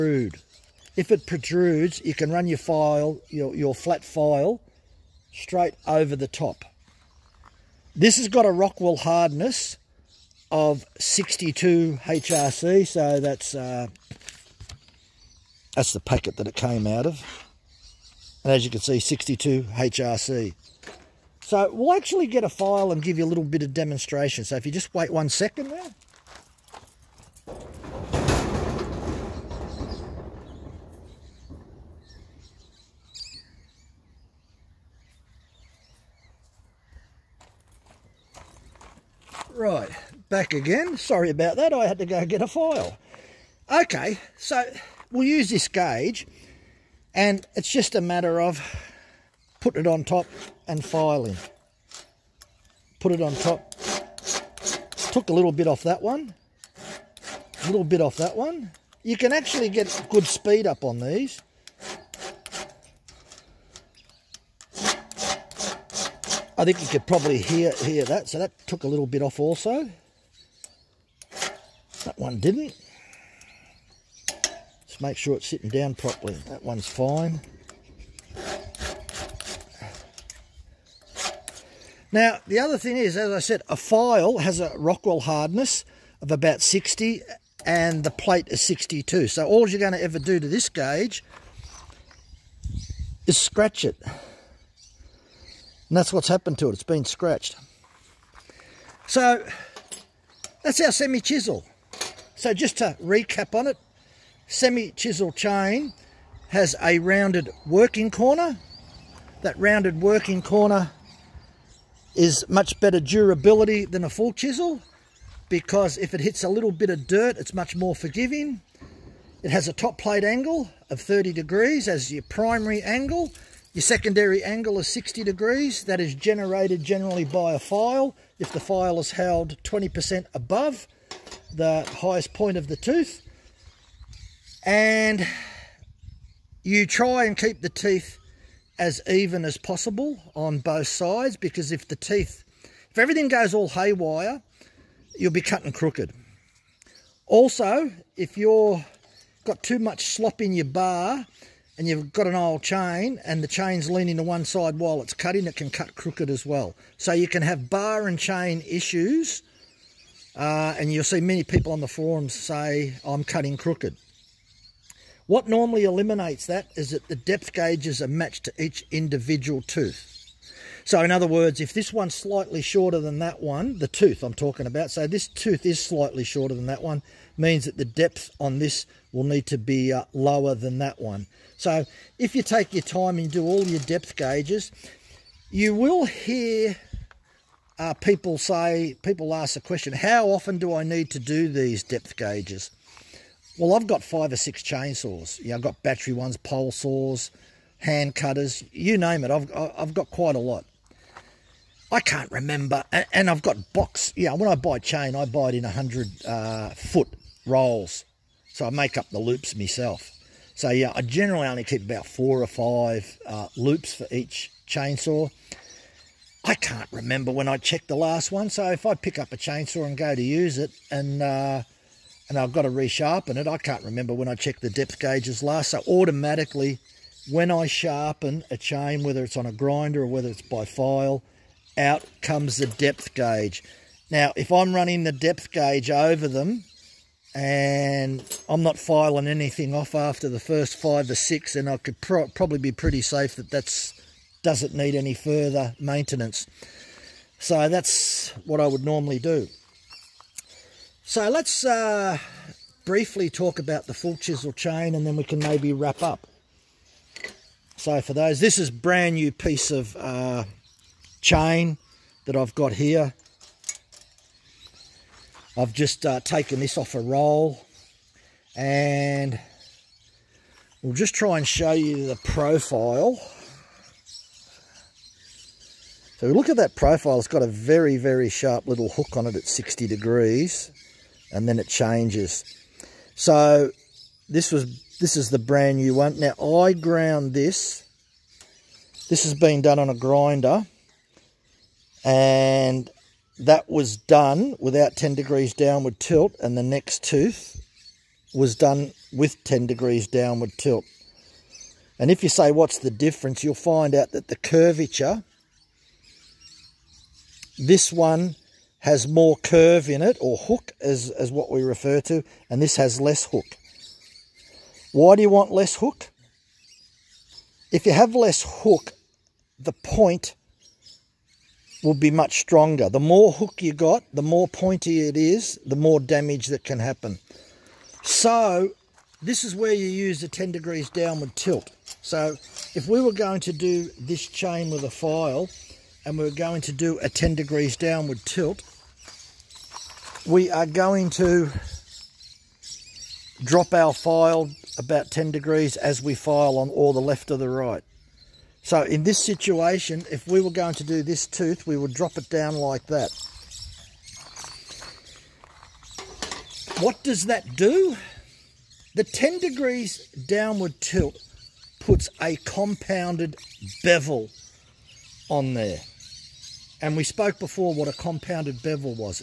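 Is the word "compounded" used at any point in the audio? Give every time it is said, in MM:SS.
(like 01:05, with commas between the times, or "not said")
06:02, 06:07.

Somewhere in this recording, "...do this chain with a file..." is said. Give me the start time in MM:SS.
05:33.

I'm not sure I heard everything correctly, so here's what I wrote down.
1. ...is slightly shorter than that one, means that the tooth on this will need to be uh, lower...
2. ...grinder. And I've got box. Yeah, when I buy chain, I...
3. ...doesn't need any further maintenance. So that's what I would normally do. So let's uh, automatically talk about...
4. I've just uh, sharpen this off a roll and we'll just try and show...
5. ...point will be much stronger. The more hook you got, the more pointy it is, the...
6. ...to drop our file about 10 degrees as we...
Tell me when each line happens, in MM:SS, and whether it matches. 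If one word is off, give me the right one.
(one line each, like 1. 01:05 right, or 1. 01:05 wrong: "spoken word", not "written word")
1. 02:55 wrong: "depth", not "tooth"
2. 03:22 wrong: "remember", not "grinder"
3. 04:04 wrong: "briefly", not "automatically"
4. 04:25 wrong: "taken", not "sharpen"
5. 05:19 right
6. 05:41 right.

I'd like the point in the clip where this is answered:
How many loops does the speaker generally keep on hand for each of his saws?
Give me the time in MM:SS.
03:32.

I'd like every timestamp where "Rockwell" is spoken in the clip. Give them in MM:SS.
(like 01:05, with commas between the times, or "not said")
00:08, 01:24.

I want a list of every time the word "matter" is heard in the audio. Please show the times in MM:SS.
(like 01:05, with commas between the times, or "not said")
00:48.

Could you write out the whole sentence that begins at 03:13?
Well, I've got five or six chainsaws.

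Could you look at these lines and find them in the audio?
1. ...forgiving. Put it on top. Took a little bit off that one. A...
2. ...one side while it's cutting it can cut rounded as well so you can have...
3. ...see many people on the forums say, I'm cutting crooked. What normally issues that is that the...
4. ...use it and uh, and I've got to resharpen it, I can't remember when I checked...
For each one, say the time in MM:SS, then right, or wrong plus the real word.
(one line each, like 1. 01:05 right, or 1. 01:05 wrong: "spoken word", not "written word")
1. 00:50 wrong: "filing", not "forgiving"
2. 02:34 wrong: "crooked", not "rounded"
3. 02:41 wrong: "eliminates", not "issues"
4. 03:40 right.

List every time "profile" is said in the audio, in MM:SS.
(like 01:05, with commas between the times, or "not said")
04:32, 04:36.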